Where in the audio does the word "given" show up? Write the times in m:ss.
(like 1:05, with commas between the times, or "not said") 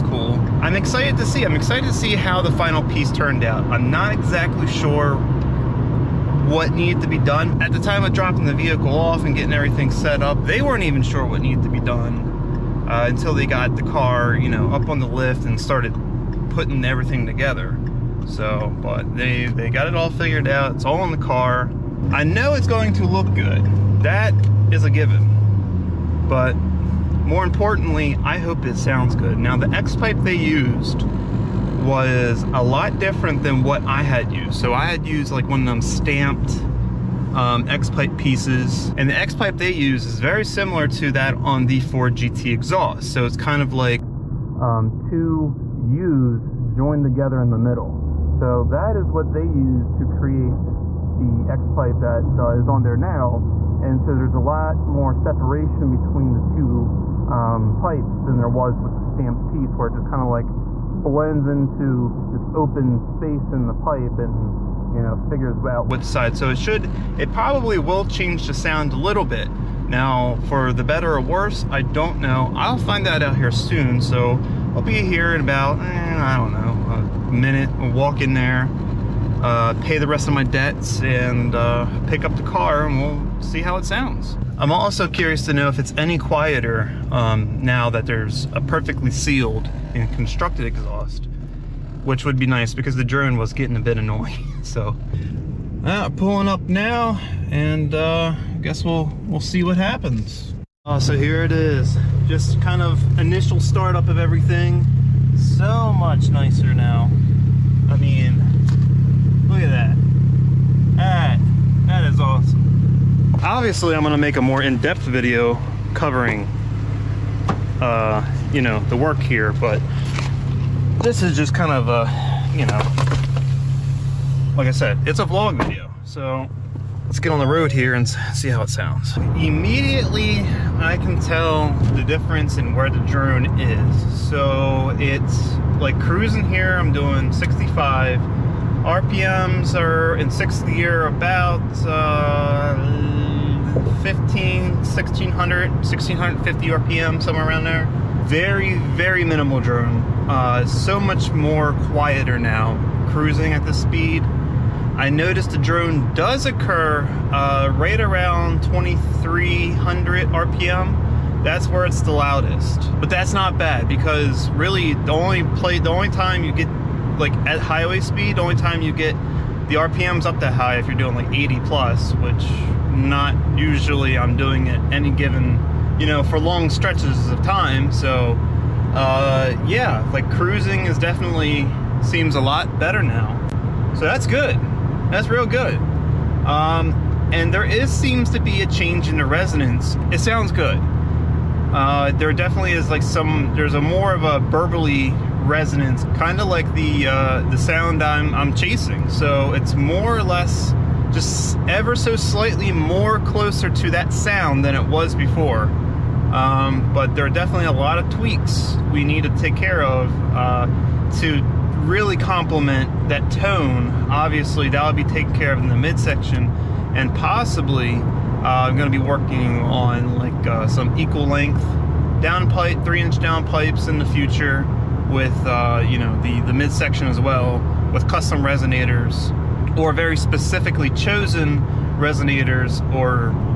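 0:24, 2:55.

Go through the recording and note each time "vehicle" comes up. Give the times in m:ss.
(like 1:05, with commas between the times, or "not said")
0:08.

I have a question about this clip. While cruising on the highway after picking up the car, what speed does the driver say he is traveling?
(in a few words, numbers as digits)
65.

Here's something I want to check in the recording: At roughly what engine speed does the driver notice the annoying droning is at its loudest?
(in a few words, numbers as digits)
2300 RPM.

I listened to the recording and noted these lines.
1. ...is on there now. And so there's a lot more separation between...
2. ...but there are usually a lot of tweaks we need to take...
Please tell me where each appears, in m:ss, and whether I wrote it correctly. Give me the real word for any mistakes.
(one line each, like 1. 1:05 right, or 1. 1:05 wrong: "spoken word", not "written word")
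1. 0:52 right
2. 3:26 wrong: "definitely", not "usually".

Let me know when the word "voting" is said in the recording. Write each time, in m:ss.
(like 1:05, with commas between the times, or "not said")
not said.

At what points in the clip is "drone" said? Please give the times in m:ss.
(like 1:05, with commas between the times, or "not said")
1:33, 2:13, 2:29, 2:35.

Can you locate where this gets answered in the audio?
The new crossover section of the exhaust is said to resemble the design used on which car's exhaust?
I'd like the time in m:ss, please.
0:41.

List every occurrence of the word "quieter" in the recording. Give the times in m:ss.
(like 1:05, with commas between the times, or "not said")
1:26, 2:31.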